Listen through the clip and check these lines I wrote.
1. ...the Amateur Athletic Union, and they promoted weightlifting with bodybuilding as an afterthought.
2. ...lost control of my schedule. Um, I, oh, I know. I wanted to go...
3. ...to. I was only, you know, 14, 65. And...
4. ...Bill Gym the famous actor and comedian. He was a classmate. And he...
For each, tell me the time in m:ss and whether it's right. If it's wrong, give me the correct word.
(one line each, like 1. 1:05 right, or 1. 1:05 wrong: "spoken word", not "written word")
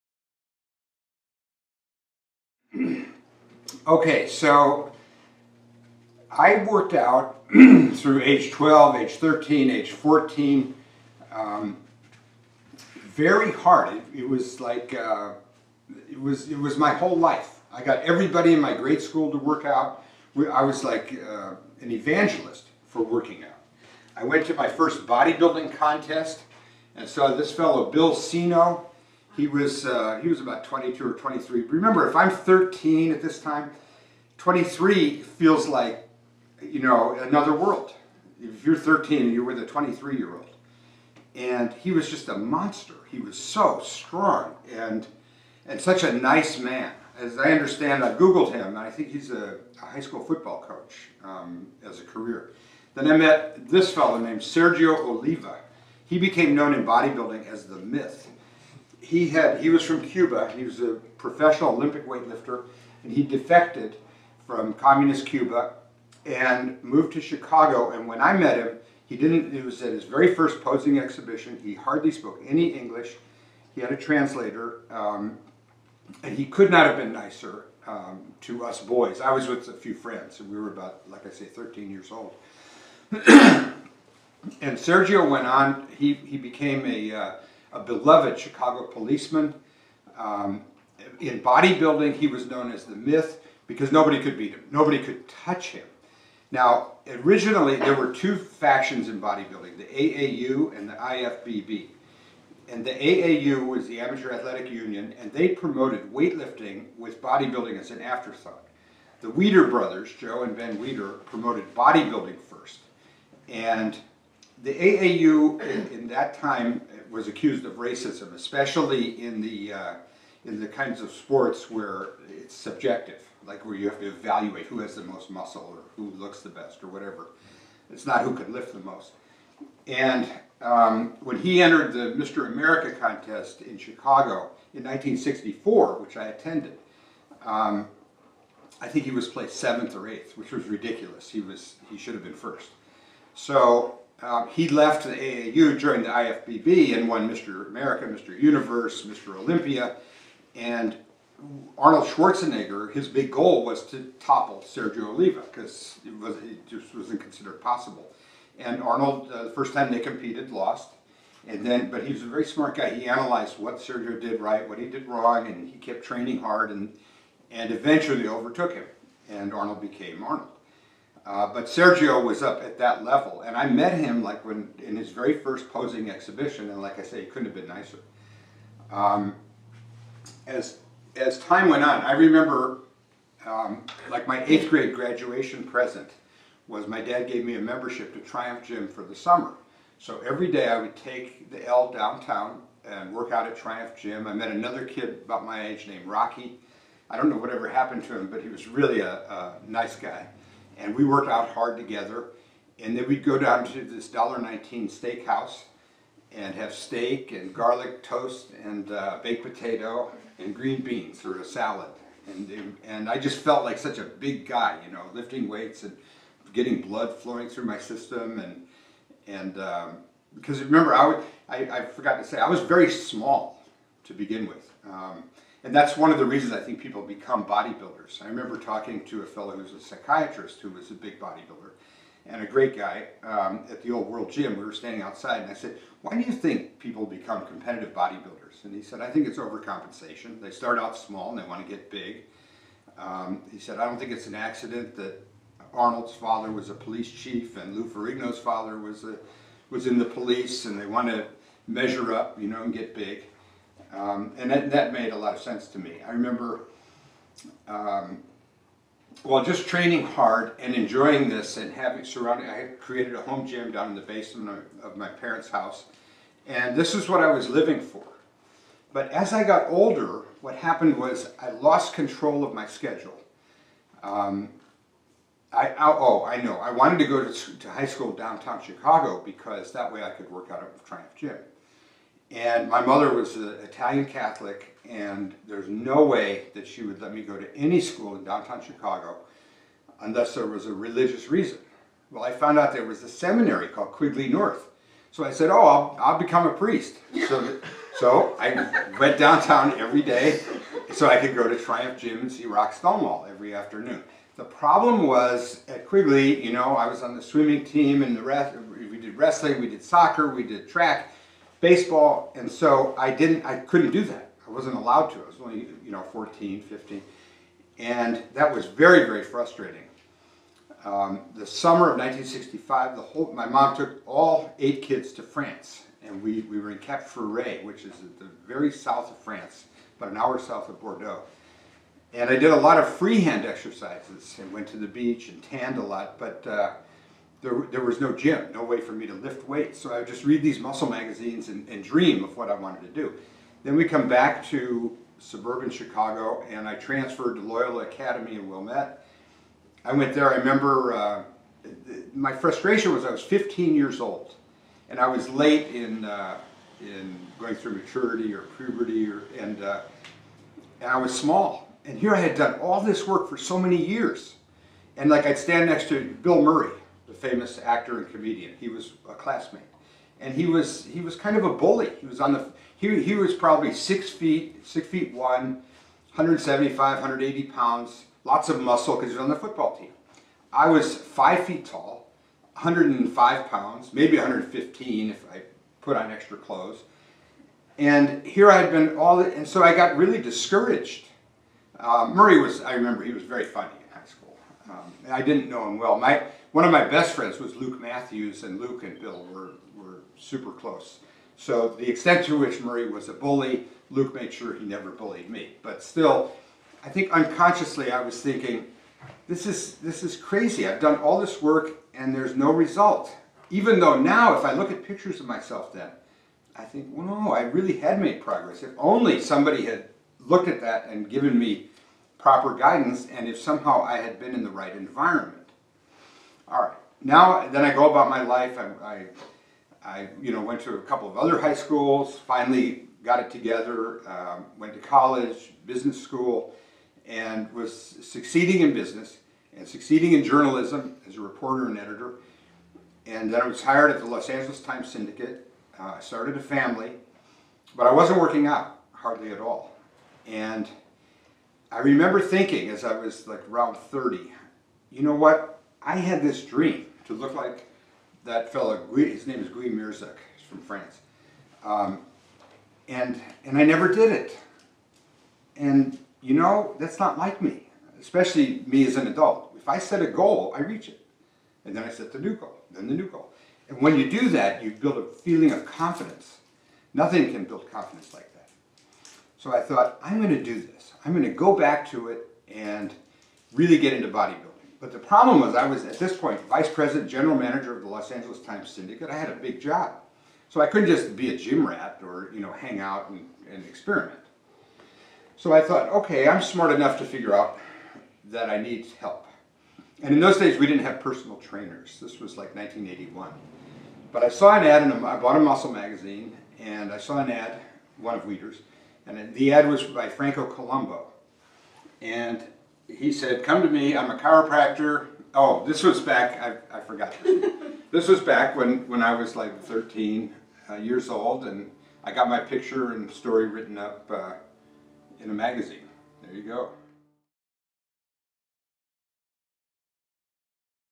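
1. 1:43 right
2. 4:31 right
3. 5:15 wrong: "15", not "65"
4. 6:06 wrong: "Murray", not "Gym".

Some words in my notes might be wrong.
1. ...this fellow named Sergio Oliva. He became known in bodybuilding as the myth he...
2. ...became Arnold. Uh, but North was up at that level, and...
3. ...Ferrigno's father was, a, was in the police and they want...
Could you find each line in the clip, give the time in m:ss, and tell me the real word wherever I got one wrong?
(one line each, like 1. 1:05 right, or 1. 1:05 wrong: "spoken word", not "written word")
1. 0:53 right
2. 2:49 wrong: "Sergio", not "North"
3. 4:07 right.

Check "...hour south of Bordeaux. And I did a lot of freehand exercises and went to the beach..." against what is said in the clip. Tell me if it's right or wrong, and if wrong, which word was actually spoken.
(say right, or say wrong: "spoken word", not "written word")
right.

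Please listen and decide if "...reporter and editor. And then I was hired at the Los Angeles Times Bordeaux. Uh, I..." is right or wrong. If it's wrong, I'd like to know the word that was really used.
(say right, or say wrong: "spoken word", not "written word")
wrong: "Syndicate", not "Bordeaux".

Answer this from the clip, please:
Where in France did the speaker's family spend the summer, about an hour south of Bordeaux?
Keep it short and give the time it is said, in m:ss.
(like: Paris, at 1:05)
Cap Ferret, at 5:26.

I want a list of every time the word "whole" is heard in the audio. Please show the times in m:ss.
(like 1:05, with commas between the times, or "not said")
0:16, 5:23.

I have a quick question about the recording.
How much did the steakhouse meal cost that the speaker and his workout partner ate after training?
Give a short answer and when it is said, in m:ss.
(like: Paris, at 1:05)
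$1.19, at 3:24.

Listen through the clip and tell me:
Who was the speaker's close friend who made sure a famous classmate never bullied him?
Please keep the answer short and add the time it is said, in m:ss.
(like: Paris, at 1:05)
Luke Matthews, at 6:37.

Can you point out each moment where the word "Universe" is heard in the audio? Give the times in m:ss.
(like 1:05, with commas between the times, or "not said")
2:28.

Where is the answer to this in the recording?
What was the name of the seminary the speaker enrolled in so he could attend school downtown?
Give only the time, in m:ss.
4:53.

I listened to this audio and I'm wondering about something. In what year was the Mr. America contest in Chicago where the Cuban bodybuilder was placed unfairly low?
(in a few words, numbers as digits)
1964.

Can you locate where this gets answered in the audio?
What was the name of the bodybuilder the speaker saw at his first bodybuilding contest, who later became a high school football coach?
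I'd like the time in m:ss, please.
0:27.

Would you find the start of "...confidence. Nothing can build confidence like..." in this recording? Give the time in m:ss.
7:55.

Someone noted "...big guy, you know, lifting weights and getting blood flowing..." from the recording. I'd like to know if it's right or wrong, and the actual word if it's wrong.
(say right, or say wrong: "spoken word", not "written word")
right.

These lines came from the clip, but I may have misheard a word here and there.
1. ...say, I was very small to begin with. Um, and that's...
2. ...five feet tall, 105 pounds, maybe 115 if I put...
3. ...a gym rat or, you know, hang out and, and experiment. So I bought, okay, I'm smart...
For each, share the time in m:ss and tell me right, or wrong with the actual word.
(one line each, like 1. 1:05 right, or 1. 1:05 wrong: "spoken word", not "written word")
1. 3:42 right
2. 6:20 right
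3. 8:11 wrong: "thought", not "bought".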